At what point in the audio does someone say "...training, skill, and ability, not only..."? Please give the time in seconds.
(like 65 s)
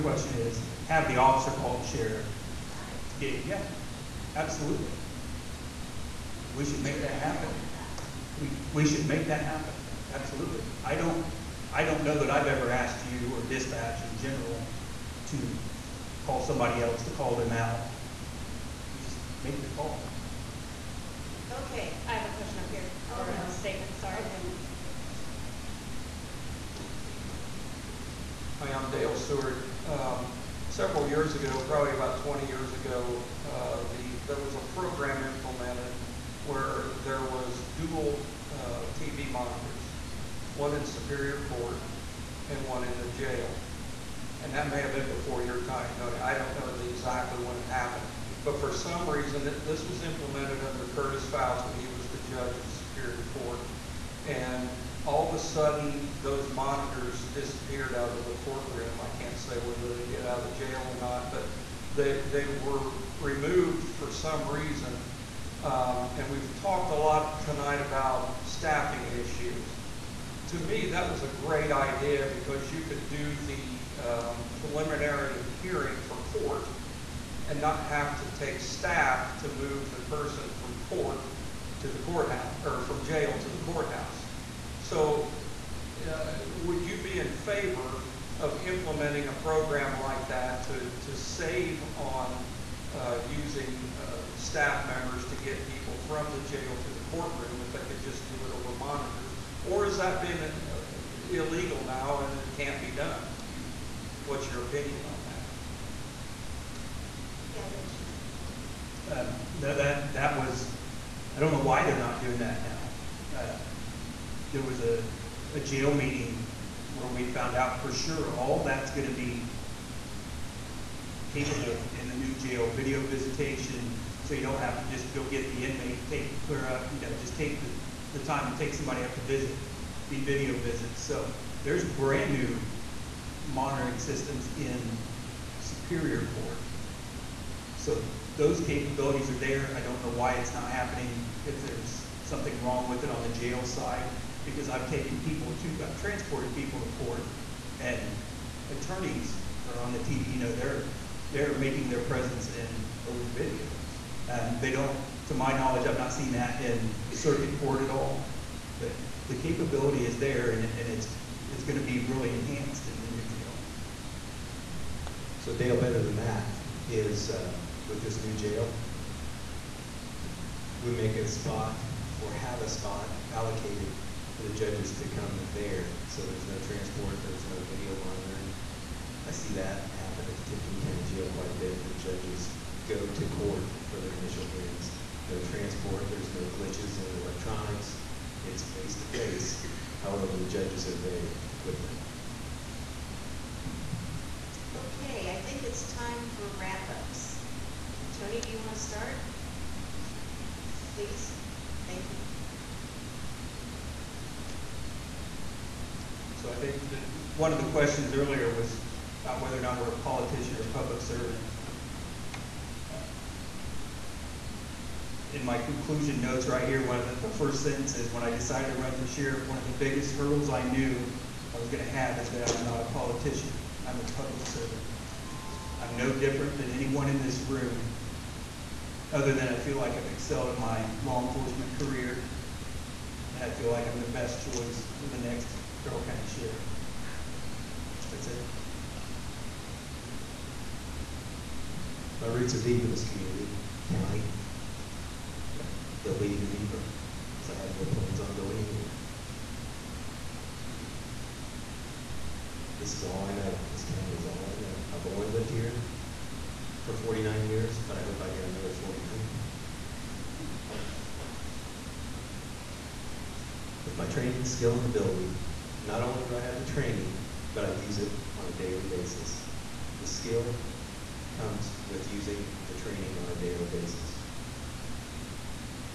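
264 s.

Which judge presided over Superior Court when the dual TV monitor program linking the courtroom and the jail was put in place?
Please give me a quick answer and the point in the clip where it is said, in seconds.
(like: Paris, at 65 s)
Curtis Fouts, at 50 s.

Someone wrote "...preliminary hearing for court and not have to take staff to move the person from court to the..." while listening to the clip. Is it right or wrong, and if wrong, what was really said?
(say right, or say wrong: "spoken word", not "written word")
right.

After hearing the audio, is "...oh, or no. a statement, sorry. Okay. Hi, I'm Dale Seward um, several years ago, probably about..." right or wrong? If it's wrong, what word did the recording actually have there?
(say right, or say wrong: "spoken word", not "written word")
right.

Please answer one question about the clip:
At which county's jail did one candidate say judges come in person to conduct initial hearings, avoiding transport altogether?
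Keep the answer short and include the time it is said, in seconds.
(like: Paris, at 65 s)
Tippecanoe County, at 180 s.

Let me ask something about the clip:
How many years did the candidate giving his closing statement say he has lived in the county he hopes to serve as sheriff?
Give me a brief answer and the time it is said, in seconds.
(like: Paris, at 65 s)
49, at 256 s.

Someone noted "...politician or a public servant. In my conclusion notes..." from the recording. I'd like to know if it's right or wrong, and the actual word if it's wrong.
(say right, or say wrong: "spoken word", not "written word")
right.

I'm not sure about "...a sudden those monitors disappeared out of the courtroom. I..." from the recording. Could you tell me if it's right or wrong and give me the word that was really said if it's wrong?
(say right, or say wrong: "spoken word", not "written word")
right.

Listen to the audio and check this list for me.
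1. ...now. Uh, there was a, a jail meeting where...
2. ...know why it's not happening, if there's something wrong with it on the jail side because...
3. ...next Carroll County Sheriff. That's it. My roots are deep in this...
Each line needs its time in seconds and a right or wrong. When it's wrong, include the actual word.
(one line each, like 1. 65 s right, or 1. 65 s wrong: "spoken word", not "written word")
1. 112 s right
2. 140 s right
3. 235 s right.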